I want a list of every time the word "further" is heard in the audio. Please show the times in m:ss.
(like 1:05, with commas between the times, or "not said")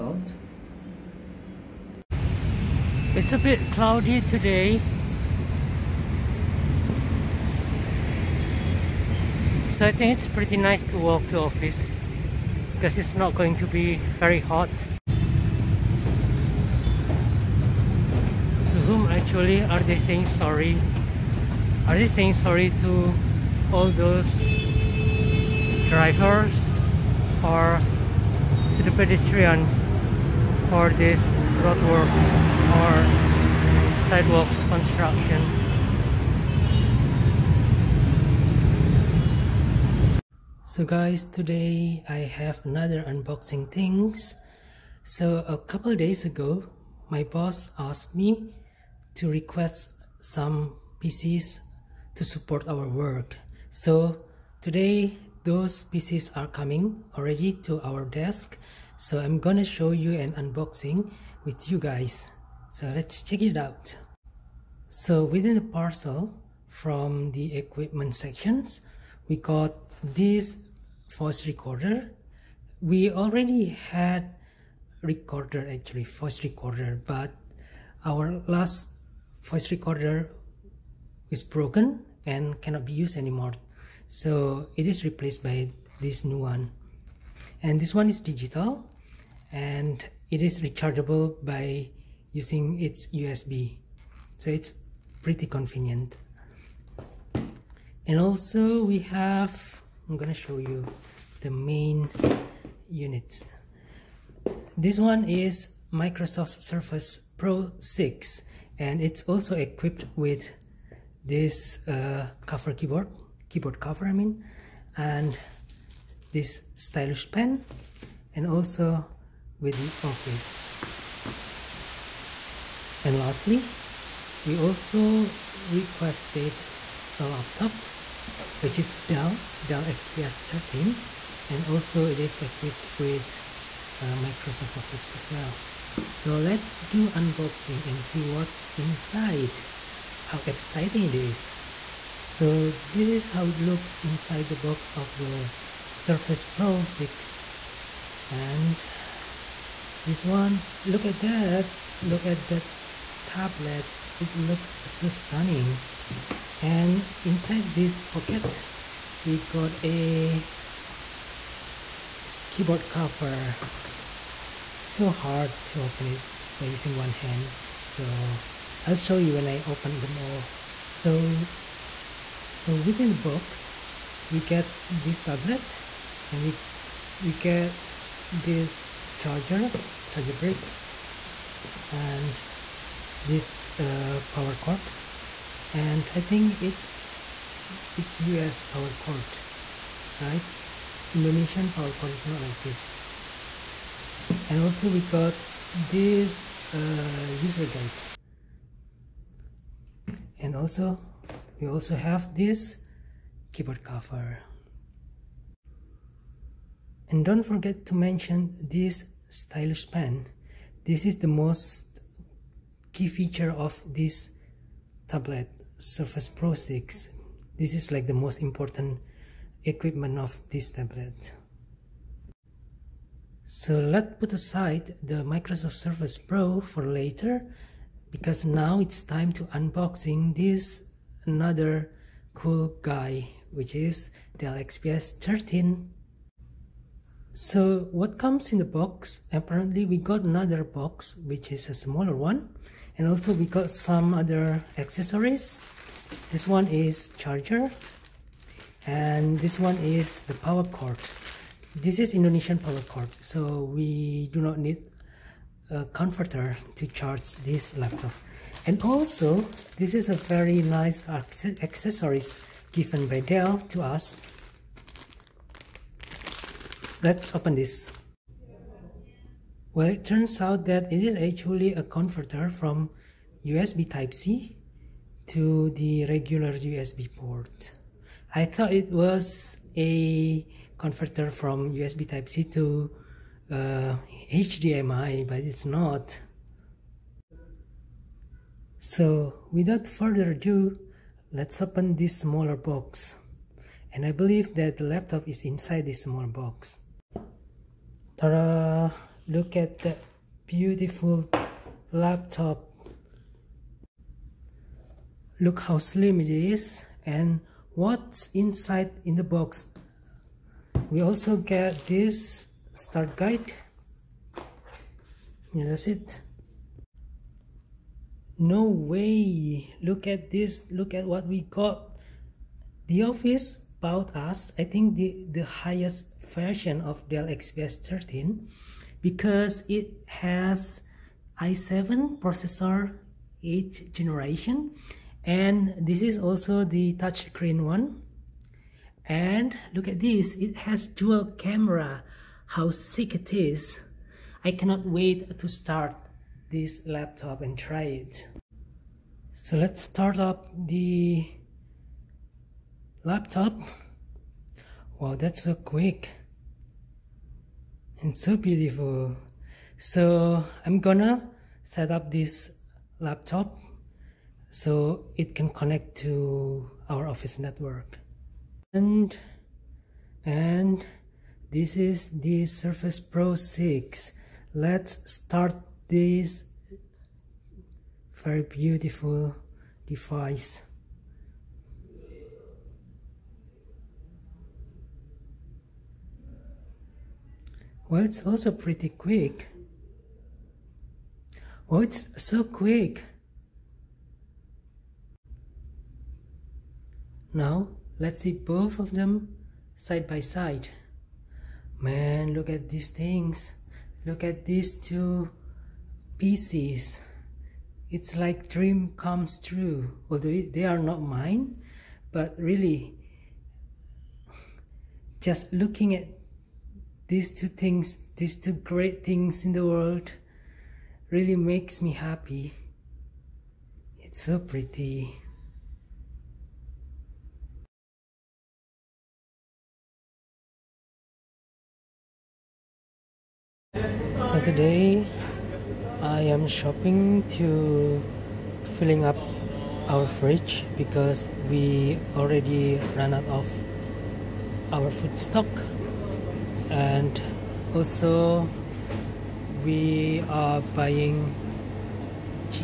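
4:49.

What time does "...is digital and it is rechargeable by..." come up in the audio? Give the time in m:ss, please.
1:28.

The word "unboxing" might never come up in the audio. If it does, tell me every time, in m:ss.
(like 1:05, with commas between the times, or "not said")
0:43, 1:00, 2:17, 3:49.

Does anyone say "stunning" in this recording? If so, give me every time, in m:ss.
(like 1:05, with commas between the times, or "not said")
2:35.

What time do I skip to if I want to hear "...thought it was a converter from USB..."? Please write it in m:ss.
4:38.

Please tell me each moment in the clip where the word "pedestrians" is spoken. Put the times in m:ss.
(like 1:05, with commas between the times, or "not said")
0:28.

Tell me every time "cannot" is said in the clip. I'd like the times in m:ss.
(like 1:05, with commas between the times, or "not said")
1:22, 5:44.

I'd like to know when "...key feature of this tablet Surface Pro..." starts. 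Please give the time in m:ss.
3:32.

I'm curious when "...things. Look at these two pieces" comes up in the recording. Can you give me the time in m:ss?
6:42.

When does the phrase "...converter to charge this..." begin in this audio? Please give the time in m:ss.
4:15.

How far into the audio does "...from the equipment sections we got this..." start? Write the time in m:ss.
1:06.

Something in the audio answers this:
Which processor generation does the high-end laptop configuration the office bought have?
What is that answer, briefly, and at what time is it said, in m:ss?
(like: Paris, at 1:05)
8th generation, at 5:33.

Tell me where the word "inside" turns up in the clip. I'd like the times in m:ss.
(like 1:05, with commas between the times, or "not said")
2:18, 2:24, 2:37, 4:55, 5:08.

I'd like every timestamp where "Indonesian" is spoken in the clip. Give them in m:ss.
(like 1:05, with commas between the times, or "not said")
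3:11, 4:12.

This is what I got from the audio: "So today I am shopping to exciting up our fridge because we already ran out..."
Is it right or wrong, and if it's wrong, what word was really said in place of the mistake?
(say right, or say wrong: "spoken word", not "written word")
wrong: "filling", not "exciting".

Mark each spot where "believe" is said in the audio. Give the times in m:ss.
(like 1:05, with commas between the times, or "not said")
4:54.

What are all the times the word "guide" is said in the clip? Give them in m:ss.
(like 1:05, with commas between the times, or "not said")
3:17, 5:13.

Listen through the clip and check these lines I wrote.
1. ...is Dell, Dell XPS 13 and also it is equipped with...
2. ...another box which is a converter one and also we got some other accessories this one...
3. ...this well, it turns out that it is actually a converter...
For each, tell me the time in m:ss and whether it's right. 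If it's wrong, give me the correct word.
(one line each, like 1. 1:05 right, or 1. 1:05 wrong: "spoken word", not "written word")
1. 2:08 right
2. 4:00 wrong: "smaller", not "converter"
3. 4:27 right.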